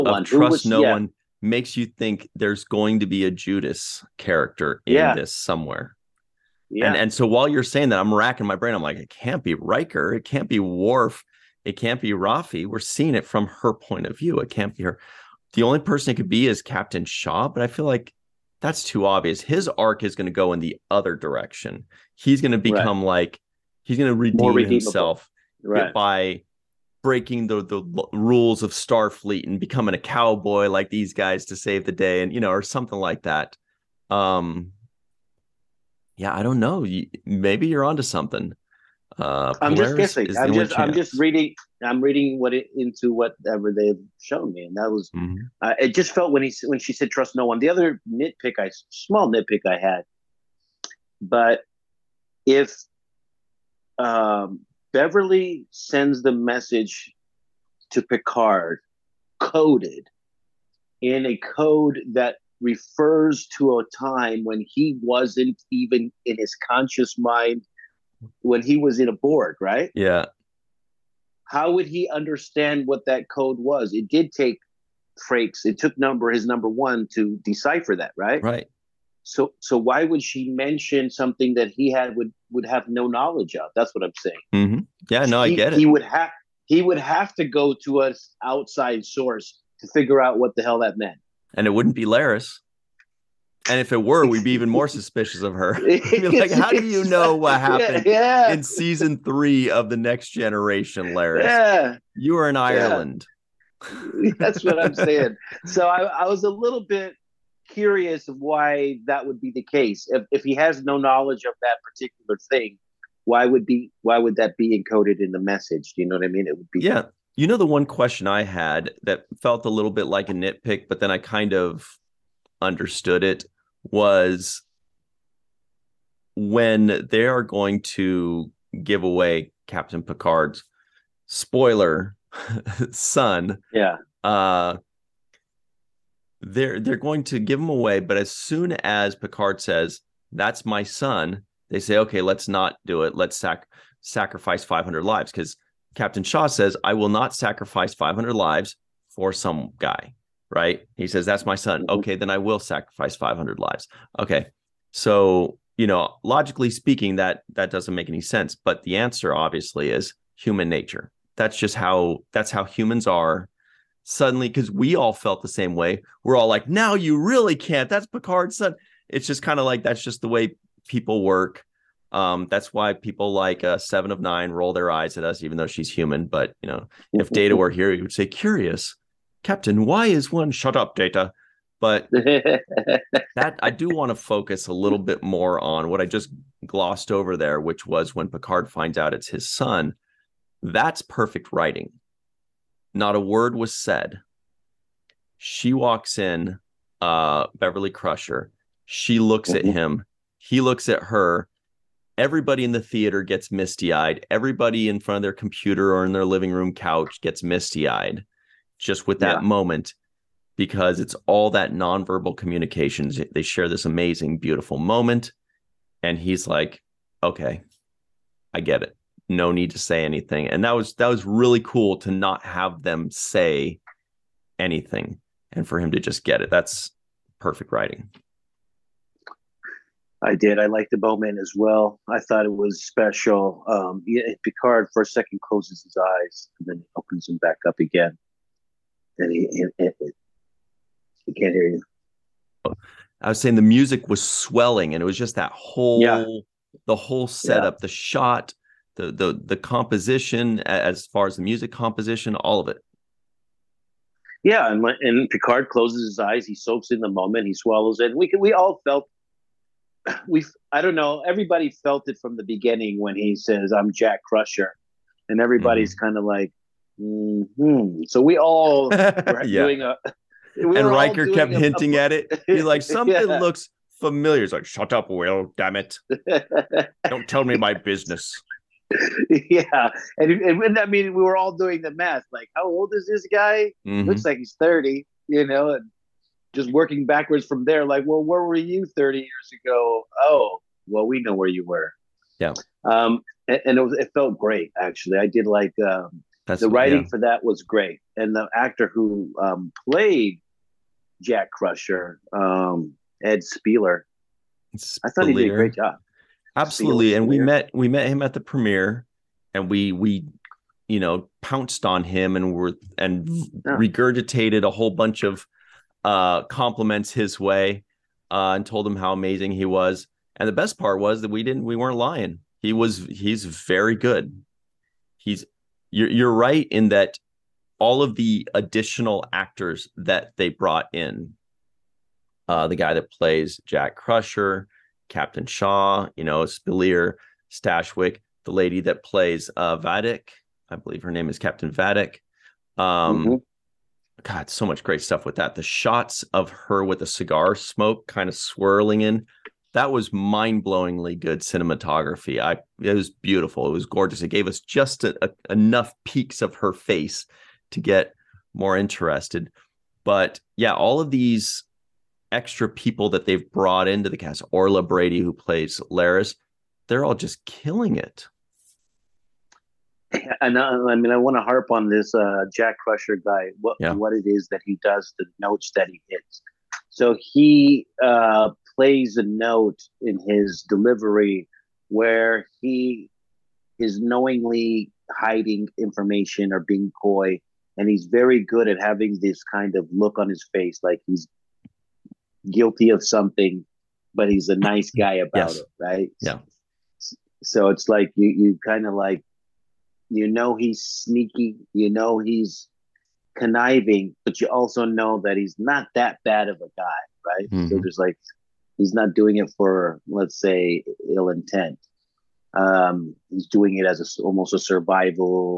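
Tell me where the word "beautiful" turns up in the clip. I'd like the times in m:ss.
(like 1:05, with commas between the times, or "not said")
3:34, 5:53.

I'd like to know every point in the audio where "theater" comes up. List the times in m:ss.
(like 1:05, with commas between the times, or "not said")
3:22.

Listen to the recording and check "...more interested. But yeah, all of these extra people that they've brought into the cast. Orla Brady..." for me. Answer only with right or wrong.
right.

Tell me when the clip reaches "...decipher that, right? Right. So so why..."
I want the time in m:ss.
1:17.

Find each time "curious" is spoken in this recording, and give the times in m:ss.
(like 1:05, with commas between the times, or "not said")
1:47, 2:58.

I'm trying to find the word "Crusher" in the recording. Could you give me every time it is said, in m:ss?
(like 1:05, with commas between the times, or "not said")
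3:17, 4:24, 5:01, 5:33, 6:12.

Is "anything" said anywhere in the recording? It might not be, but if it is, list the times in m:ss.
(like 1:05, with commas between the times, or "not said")
3:40, 3:44.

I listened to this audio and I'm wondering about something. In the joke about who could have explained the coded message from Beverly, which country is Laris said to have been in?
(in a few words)
Ireland.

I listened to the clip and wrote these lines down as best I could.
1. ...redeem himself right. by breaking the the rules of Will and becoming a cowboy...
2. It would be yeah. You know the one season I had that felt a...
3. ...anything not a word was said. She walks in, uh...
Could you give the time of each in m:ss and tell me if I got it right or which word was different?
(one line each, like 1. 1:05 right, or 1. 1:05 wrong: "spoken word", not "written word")
1. 0:24 wrong: "Starfleet", not "Will"
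2. 1:56 wrong: "question", not "season"
3. 3:11 wrong: "writing", not "anything".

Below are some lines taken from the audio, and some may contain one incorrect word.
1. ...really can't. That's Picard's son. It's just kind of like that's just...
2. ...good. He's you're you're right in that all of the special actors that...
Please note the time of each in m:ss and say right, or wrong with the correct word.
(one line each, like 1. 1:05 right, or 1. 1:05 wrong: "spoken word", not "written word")
1. 2:47 right
2. 5:23 wrong: "additional", not "special".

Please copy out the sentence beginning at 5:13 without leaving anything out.
regurgitated a whole bunch of uh compliments his way uh and told him how amazing he was.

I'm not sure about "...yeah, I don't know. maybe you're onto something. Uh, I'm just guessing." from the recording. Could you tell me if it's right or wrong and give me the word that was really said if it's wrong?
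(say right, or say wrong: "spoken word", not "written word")
right.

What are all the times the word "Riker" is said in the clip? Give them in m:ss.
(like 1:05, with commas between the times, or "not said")
0:09, 4:30.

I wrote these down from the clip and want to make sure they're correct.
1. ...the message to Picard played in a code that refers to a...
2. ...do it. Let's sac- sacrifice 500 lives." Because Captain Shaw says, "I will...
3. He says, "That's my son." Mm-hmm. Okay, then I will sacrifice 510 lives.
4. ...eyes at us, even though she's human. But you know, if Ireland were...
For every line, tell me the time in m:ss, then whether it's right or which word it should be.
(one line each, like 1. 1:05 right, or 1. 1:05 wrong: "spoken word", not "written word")
1. 0:56 wrong: "coded", not "played"
2. 2:22 right
3. 2:30 wrong: "500", not "510"
4. 2:54 wrong: "Data", not "Ireland".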